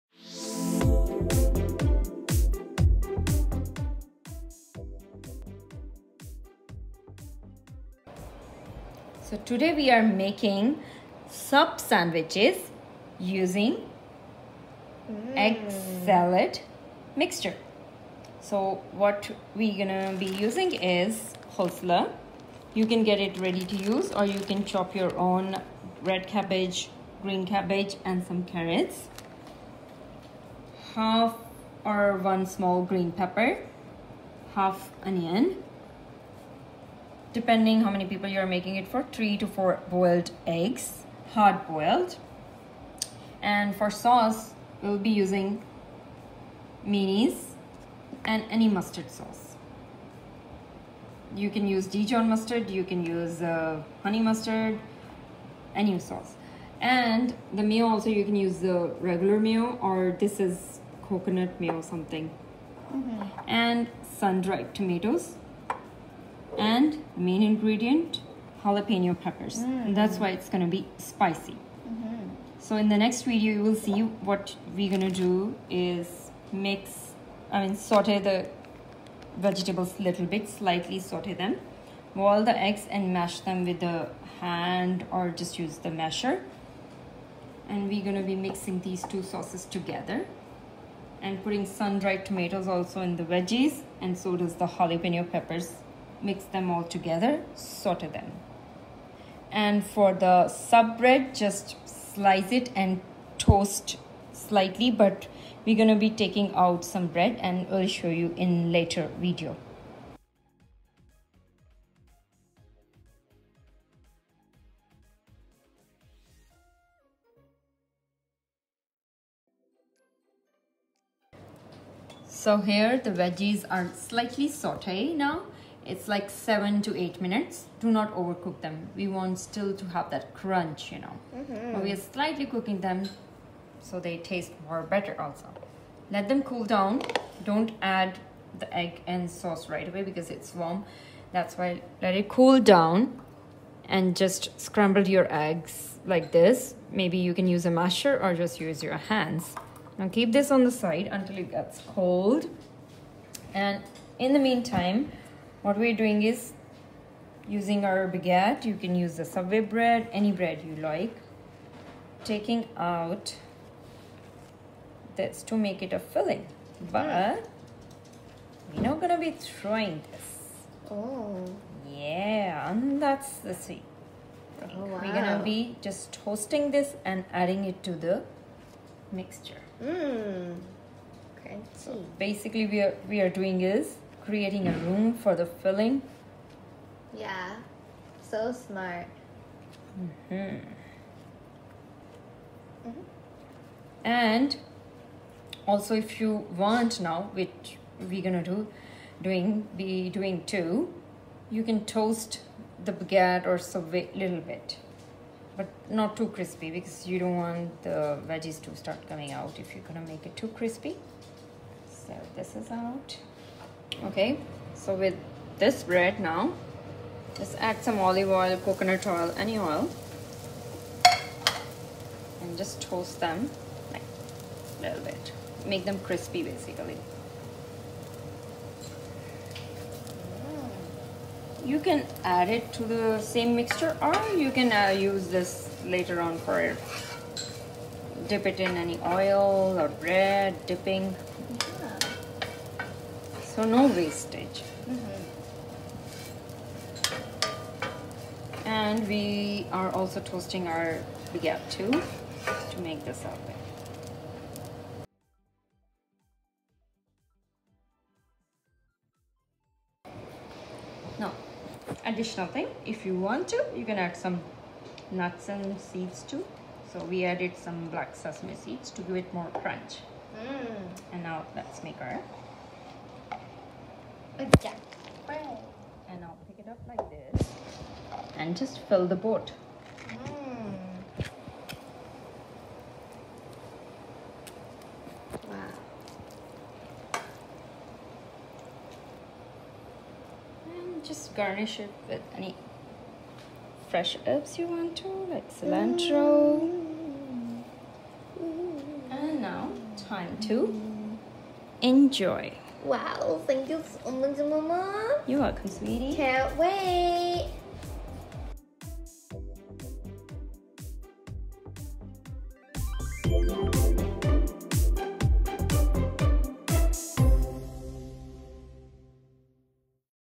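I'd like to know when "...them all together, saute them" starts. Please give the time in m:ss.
1:36.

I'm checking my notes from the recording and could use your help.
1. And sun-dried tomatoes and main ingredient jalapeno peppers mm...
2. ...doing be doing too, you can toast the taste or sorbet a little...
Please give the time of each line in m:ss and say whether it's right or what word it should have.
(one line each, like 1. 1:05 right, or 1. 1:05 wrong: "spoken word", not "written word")
1. 1:03 right
2. 3:19 wrong: "baguette", not "taste".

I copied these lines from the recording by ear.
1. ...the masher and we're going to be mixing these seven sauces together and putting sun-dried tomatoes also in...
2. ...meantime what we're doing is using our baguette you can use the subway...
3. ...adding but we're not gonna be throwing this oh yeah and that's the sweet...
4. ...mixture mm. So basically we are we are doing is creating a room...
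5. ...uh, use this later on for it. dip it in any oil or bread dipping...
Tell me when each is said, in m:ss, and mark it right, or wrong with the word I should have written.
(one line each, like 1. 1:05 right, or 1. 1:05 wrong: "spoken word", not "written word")
1. 1:25 wrong: "two", not "seven"
2. 2:34 right
3. 2:45 wrong: "filling", not "adding"
4. 2:59 right
5. 3:54 right.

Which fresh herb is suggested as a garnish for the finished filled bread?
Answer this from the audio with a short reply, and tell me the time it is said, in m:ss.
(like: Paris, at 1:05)
cilantro, at 4:55.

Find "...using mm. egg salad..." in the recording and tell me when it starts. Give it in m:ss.
0:13.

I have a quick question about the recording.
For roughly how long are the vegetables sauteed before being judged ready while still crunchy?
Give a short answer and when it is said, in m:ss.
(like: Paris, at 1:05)
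7 to 8 minutes, at 2:06.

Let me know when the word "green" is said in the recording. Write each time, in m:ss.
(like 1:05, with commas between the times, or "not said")
0:27, 0:32.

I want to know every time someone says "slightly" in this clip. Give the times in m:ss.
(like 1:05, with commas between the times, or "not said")
1:20, 1:44, 2:03, 2:12.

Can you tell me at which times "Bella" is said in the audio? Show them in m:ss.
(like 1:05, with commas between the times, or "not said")
not said.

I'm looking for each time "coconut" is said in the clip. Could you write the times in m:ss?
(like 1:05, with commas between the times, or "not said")
1:01, 3:38.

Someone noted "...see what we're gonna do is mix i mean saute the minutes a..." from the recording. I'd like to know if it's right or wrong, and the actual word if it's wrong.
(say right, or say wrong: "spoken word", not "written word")
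wrong: "vegetables", not "minutes".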